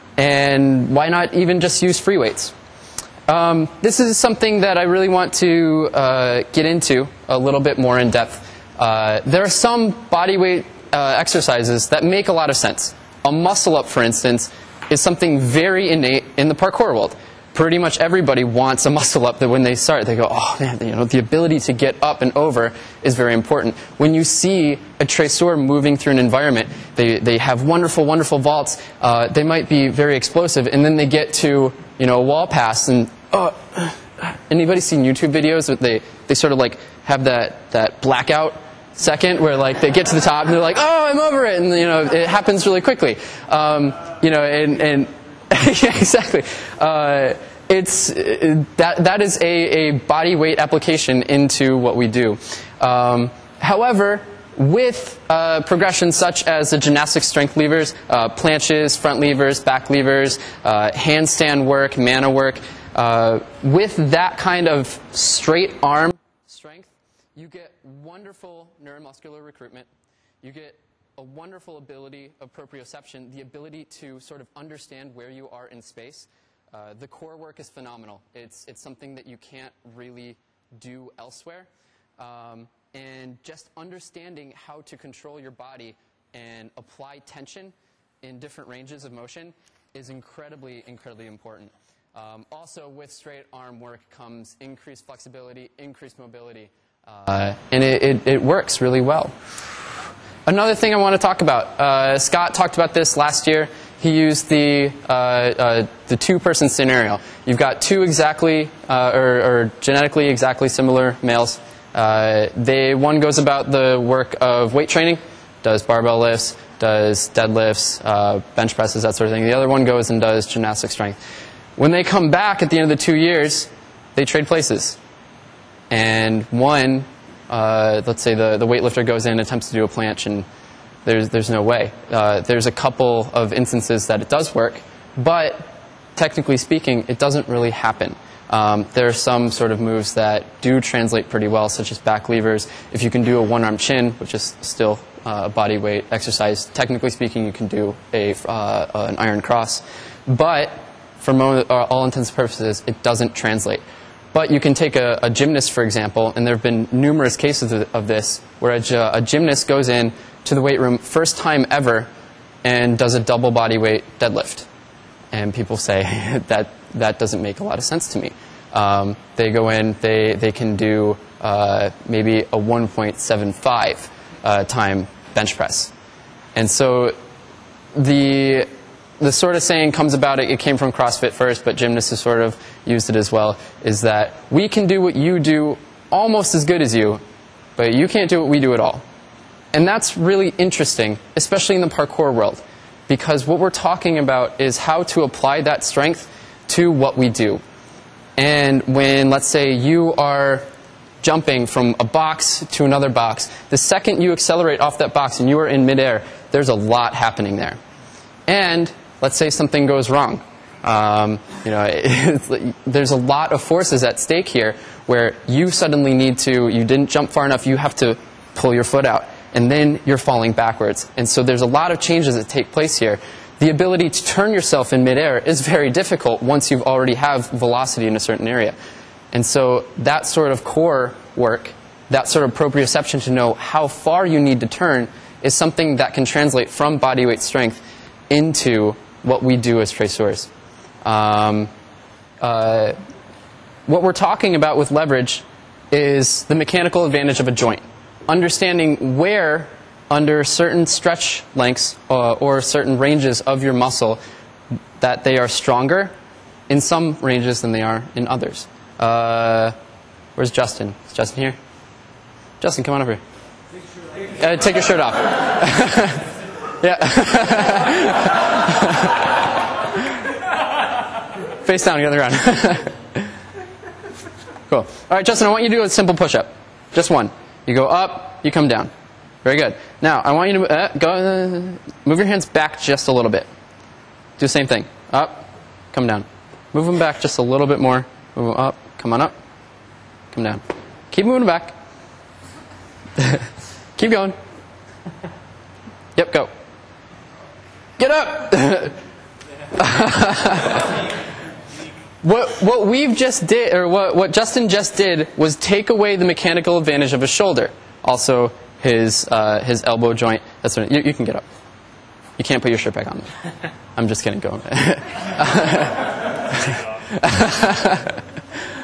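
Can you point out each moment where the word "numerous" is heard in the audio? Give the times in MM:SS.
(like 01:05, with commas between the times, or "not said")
02:36.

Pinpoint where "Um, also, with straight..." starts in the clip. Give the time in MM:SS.
01:32.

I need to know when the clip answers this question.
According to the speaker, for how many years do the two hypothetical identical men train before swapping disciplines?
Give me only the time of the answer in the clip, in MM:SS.
02:03.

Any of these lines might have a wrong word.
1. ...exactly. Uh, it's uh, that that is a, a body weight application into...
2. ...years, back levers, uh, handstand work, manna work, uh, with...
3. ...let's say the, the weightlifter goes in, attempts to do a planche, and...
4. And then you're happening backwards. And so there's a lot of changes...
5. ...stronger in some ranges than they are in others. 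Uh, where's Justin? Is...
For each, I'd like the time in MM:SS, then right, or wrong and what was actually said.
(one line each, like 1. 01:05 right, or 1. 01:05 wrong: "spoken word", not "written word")
1. 00:45 right
2. 00:59 wrong: "levers", not "years"
3. 02:08 right
4. 03:39 wrong: "falling", not "happening"
5. 04:15 right.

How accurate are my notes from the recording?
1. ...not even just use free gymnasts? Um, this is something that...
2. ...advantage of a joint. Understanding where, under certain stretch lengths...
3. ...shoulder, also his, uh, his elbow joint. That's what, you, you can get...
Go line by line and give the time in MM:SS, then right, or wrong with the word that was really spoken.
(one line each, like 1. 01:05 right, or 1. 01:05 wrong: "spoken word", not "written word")
1. 00:01 wrong: "weights", not "gymnasts"
2. 04:07 right
3. 05:07 right.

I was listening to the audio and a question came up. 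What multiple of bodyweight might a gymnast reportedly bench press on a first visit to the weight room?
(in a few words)
1.75.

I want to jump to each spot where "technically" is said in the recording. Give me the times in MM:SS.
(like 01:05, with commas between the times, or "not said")
02:16, 02:26.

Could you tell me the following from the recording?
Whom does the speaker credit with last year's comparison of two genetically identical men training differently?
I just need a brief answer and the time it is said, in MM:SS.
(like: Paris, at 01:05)
Scott, at 01:42.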